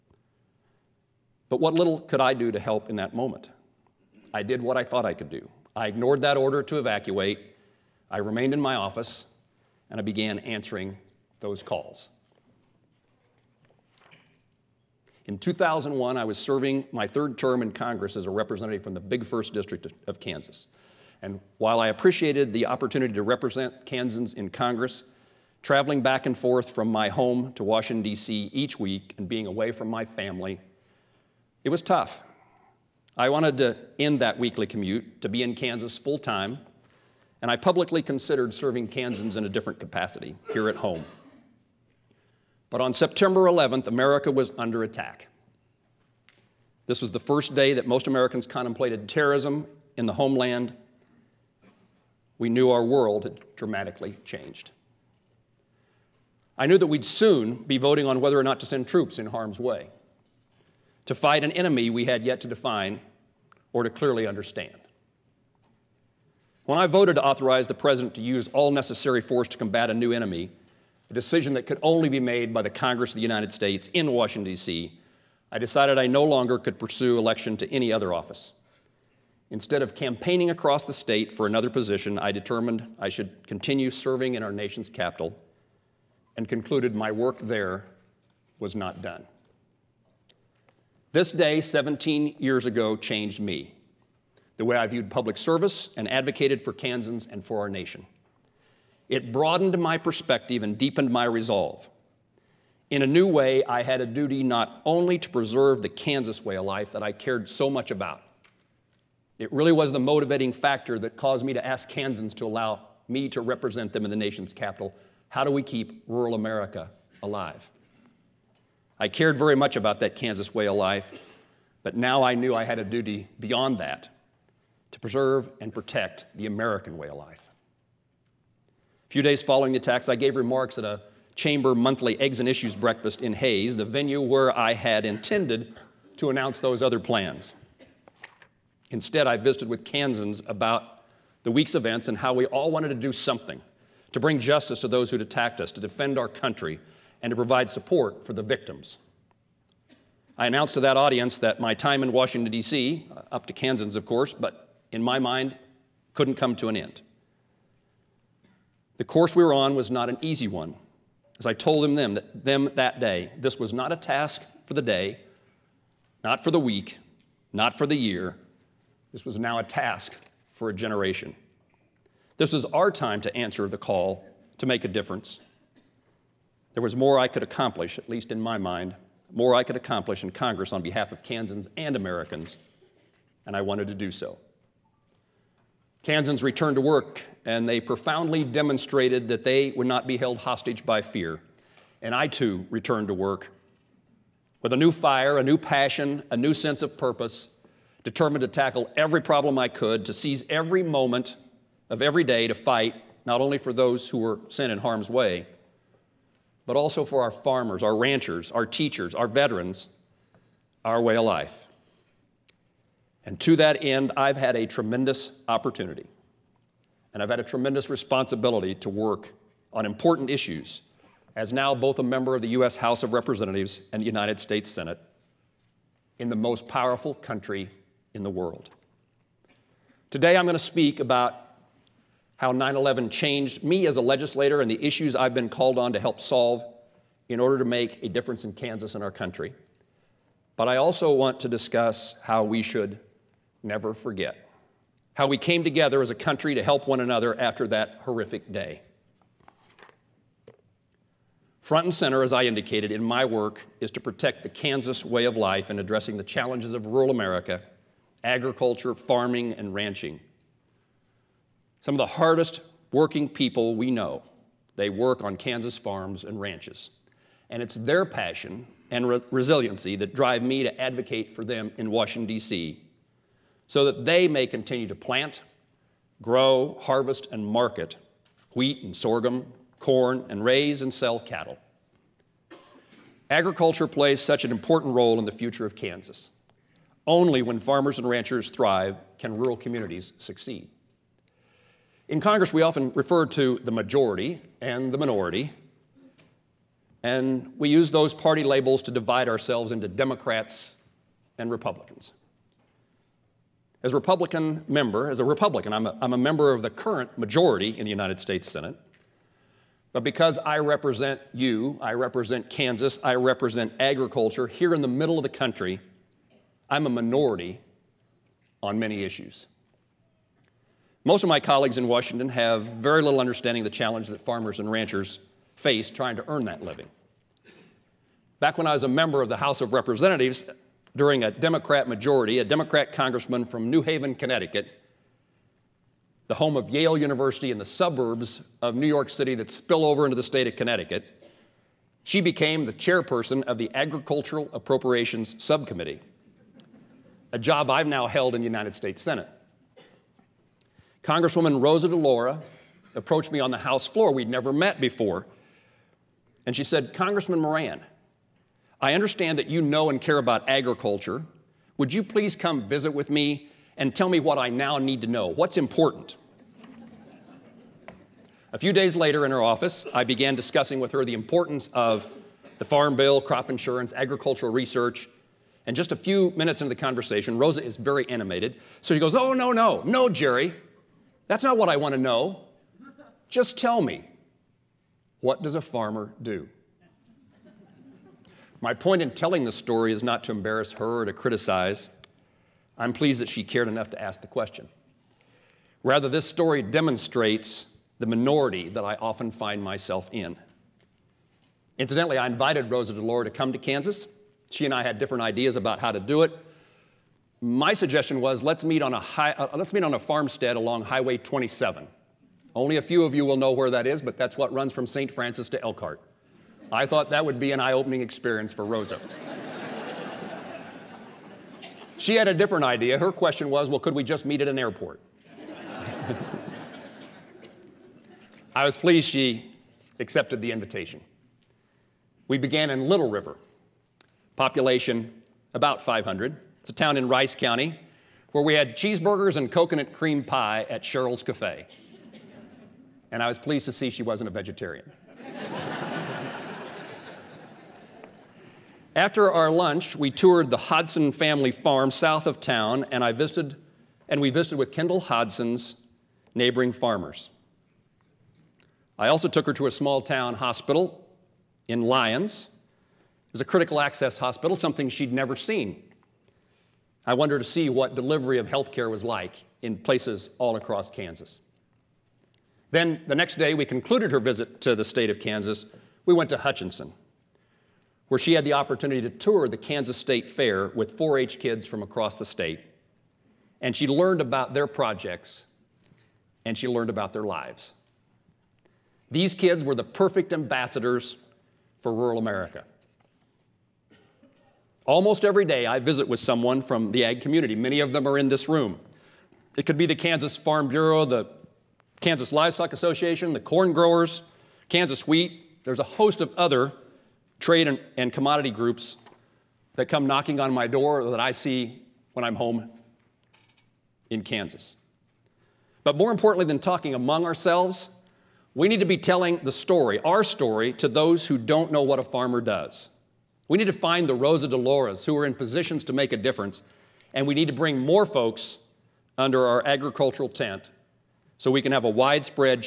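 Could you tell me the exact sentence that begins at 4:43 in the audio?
Agriculture plays such an important role in the future of Kansas.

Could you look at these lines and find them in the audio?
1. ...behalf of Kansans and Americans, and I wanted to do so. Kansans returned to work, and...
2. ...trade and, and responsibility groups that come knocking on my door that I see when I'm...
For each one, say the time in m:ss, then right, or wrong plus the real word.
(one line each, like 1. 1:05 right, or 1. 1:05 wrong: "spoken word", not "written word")
1. 3:00 right
2. 8:27 wrong: "commodity", not "responsibility".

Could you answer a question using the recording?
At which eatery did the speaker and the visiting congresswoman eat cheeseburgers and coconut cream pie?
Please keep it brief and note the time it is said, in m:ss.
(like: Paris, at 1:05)
Cheryl's Cafe, at 7:20.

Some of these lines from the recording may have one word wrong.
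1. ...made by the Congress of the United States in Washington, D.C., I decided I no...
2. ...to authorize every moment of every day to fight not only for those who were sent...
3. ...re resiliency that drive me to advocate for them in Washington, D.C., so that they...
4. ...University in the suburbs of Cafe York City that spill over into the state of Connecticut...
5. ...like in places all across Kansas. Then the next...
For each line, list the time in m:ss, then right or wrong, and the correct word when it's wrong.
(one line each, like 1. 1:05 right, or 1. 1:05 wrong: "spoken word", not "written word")
1. 1:12 right
2. 3:20 wrong: "seize", not "authorize"
3. 4:29 right
4. 5:36 wrong: "New", not "Cafe"
5. 7:49 right.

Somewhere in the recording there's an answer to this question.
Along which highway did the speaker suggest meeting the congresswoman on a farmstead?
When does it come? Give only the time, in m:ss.
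6:50.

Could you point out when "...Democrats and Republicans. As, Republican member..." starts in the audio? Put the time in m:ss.
4:59.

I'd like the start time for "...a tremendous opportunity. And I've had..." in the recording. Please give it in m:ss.
3:34.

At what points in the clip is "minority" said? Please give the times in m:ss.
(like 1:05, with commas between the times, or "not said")
4:54, 5:16, 6:38.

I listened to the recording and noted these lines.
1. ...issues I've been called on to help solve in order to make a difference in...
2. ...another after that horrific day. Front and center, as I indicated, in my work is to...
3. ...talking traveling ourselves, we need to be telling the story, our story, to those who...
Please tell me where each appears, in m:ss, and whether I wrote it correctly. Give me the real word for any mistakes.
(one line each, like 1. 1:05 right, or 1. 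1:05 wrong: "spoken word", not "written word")
1. 3:54 right
2. 4:06 right
3. 8:36 wrong: "among", not "traveling".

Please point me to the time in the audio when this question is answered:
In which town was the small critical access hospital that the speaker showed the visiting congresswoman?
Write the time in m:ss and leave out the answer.
7:41.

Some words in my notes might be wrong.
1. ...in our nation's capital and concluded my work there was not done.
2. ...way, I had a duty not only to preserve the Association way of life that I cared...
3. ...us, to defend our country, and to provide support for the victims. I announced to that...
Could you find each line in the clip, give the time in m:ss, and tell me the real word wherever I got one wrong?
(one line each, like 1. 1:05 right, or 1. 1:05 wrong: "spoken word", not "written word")
1. 1:24 right
2. 1:43 wrong: "Kansas", not "Association"
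3. 2:25 right.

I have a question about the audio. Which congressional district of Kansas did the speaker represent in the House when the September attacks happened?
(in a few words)
Big First District.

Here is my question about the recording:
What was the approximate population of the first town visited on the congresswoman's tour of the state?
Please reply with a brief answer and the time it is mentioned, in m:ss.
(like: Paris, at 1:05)
500, at 7:15.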